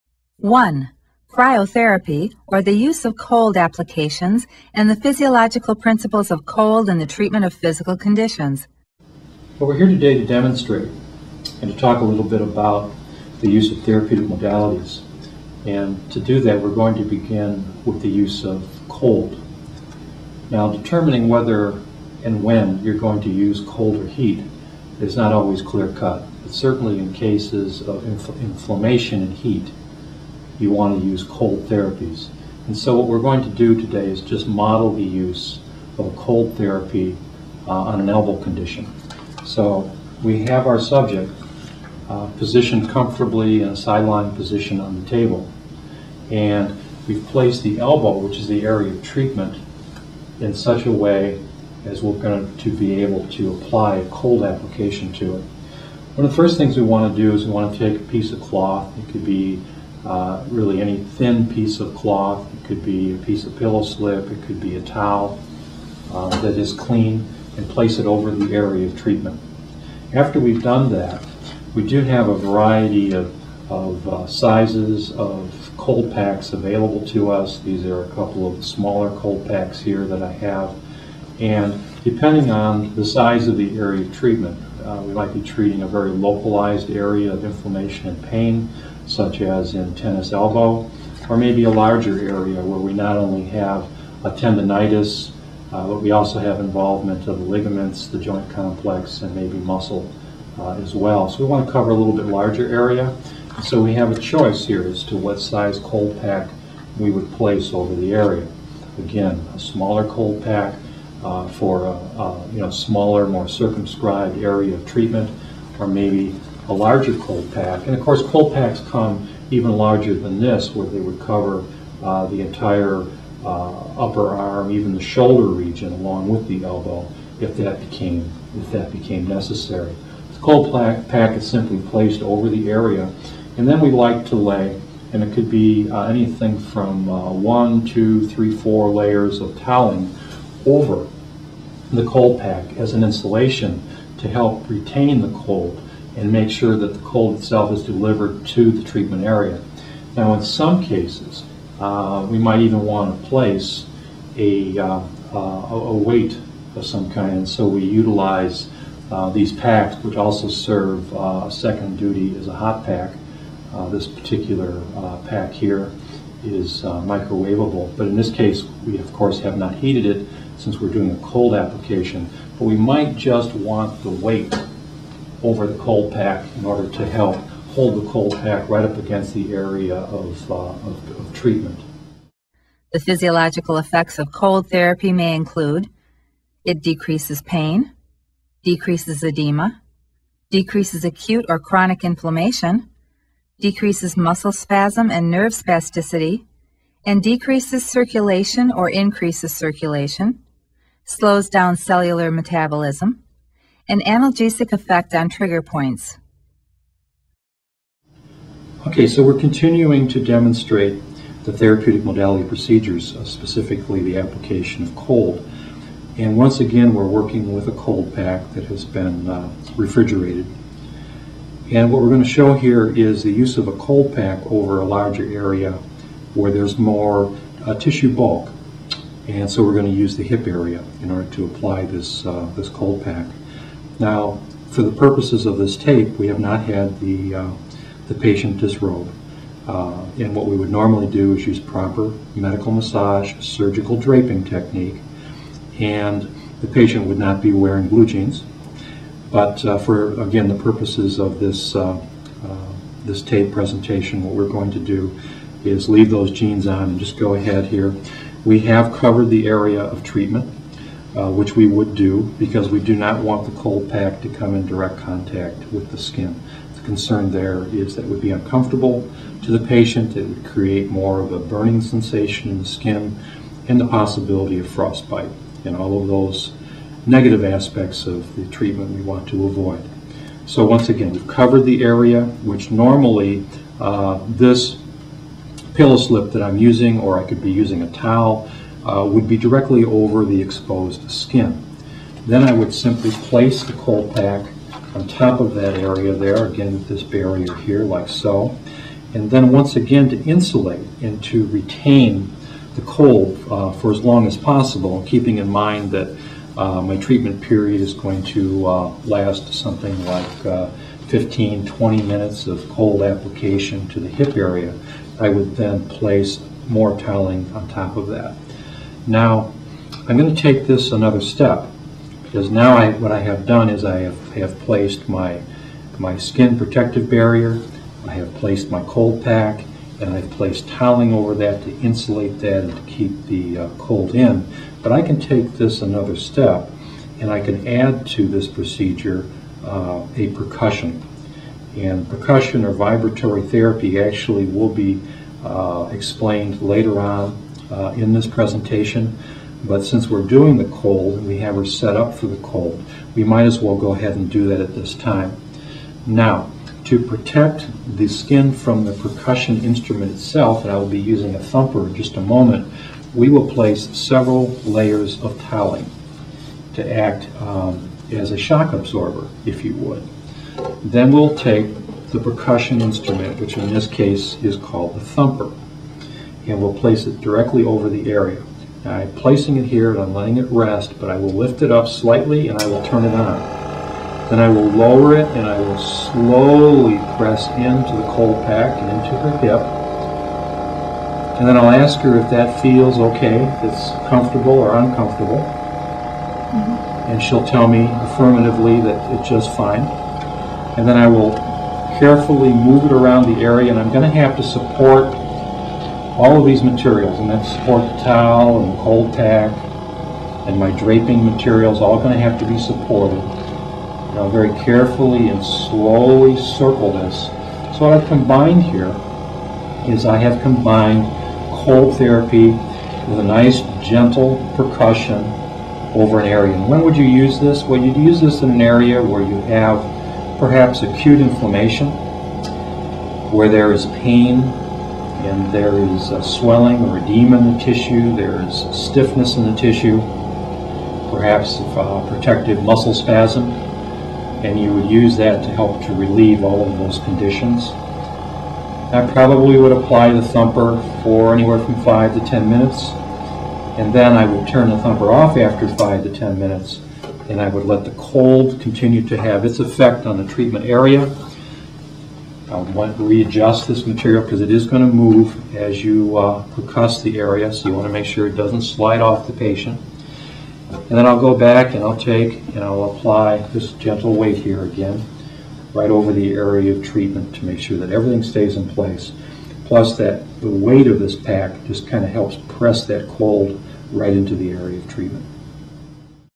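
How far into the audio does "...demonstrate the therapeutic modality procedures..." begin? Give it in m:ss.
3:30.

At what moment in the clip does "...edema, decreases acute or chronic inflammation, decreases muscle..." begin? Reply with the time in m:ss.
3:09.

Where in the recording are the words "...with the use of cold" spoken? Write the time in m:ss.
0:17.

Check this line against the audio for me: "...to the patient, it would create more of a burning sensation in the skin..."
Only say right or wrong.
right.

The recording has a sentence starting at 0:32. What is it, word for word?
And so what we're going to do today is just model the use of a cold therapy uh, on an elbow condition.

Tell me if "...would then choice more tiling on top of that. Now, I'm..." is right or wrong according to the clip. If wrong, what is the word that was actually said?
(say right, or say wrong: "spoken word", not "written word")
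wrong: "place", not "choice".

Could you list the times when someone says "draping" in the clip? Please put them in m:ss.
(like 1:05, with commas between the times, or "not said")
4:03, 6:50.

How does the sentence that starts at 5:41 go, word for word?
And percussion or vibratory therapy actually will be uh, explained later on uh, in this presentation.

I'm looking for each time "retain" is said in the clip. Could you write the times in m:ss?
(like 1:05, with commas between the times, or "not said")
2:24, 5:01.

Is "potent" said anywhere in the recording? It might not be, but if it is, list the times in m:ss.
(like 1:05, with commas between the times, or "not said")
not said.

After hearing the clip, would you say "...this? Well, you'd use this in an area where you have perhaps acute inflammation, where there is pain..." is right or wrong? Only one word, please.
right.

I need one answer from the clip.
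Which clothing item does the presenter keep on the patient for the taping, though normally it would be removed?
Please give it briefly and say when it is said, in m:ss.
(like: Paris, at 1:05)
blue jeans, at 4:07.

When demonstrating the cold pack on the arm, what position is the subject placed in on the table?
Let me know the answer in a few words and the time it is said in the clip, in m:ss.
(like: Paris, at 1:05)
sideline position, at 0:43.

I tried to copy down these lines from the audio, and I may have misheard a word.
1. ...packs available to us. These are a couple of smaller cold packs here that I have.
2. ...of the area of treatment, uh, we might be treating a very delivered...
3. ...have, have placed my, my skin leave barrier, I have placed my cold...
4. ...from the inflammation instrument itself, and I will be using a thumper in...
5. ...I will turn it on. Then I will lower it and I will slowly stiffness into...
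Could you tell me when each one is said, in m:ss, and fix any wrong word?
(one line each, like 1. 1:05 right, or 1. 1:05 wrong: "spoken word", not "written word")
1. 1:16 right
2. 1:23 wrong: "localized", not "delivered"
3. 5:23 wrong: "protective", not "leave"
4. 5:58 wrong: "percussion", not "inflammation"
5. 6:22 wrong: "press", not "stiffness".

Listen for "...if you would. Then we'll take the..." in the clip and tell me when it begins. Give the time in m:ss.
6:09.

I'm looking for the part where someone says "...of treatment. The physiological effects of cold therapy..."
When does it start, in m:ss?
3:01.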